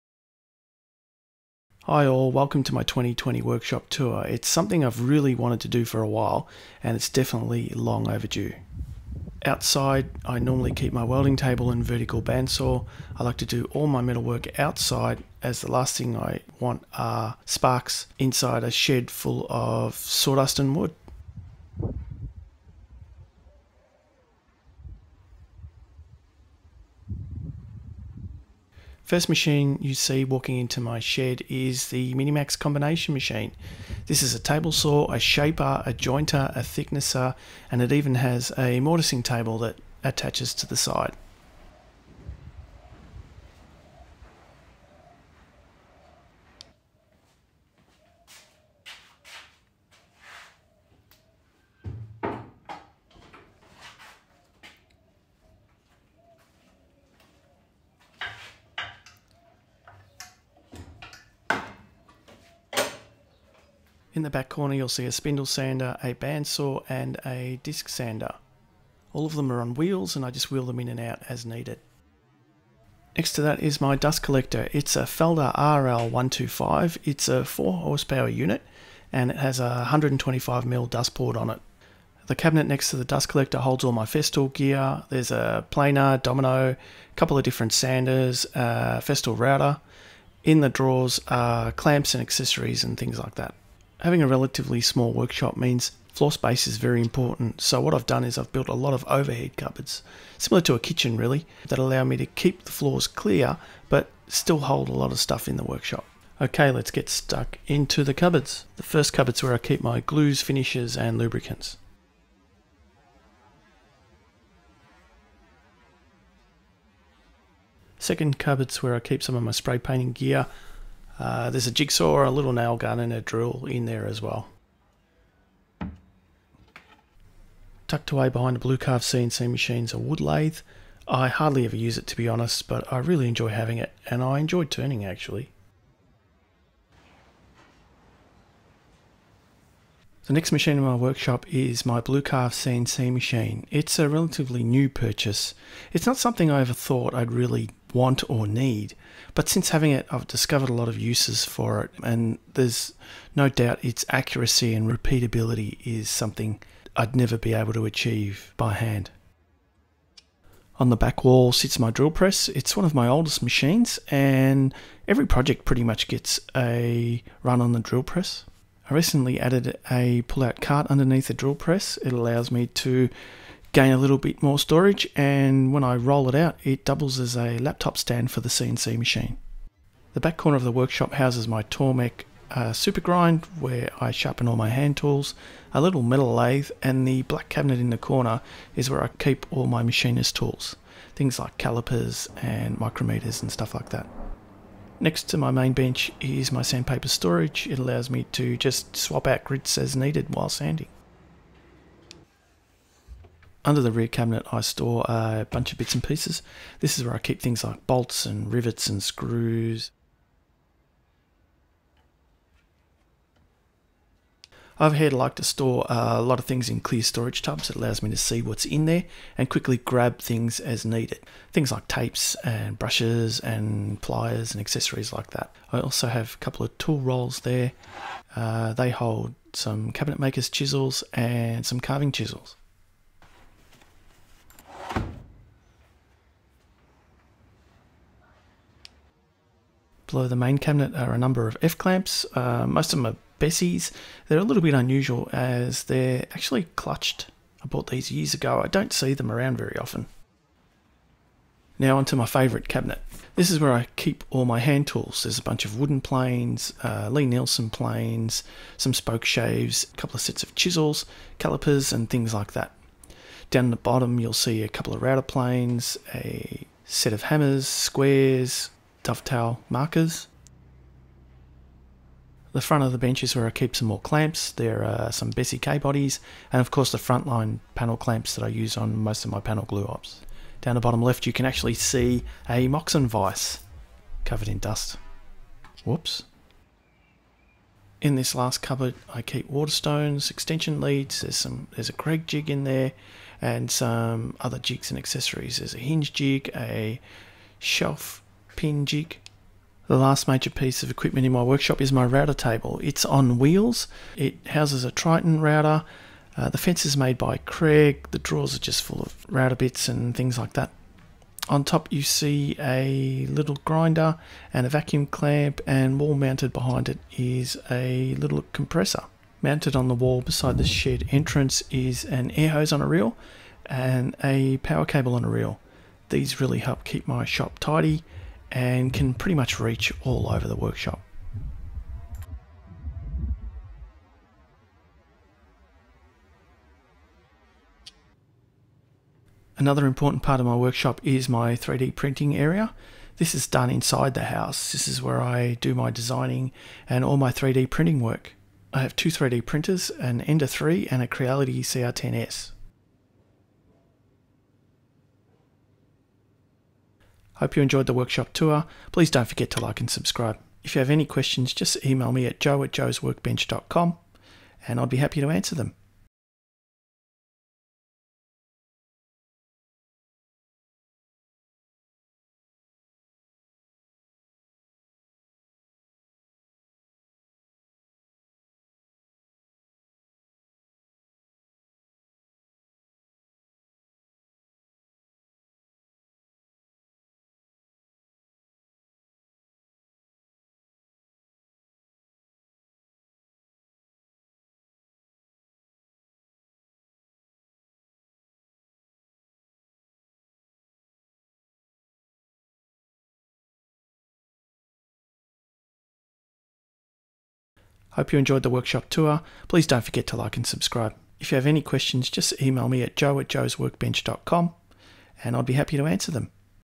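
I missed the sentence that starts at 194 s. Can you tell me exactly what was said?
Next to my main bench is my sandpaper storage.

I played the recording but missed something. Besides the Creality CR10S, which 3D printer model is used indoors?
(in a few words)
Ender 3.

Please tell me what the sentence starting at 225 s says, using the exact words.
I also have a couple of tool rolls there.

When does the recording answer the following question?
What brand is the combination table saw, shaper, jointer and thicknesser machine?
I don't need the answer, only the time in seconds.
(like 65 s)
32 s.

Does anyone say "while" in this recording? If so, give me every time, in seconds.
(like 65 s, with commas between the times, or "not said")
6 s, 200 s.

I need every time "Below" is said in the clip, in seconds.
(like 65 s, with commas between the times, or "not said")
240 s.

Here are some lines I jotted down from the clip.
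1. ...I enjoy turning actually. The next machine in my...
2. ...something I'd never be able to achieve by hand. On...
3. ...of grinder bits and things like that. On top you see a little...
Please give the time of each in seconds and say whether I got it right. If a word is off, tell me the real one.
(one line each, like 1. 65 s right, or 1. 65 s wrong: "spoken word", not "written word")
1. 134 s right
2. 156 s right
3. 309 s wrong: "router", not "grinder".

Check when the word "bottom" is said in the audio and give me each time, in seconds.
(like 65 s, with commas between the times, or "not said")
263 s, 280 s.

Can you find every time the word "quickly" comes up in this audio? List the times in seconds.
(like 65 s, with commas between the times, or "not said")
219 s.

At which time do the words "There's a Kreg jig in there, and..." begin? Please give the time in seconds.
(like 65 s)
291 s.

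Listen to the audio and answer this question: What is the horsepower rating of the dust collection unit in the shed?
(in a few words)
4 horsepower.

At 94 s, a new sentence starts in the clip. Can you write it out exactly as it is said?
Having a relatively small workshop means floor space is very important.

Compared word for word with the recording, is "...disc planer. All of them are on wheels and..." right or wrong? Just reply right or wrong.
wrong.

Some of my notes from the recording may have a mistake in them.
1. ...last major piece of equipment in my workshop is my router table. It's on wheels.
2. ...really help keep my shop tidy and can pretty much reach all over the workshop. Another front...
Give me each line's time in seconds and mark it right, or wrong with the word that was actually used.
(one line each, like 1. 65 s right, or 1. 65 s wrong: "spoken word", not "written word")
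1. 299 s right
2. 326 s wrong: "important", not "front".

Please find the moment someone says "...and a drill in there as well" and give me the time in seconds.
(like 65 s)
122 s.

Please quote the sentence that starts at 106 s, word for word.
Okay, let's get stuck into the cupboards.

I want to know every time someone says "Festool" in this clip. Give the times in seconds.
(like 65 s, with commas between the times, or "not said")
84 s, 89 s.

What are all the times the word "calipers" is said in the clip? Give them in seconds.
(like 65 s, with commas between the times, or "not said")
191 s, 261 s.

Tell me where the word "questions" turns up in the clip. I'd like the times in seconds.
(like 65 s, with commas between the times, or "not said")
361 s, 411 s.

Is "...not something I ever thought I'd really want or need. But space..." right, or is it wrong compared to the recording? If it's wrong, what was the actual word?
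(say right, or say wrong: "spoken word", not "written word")
wrong: "since", not "space".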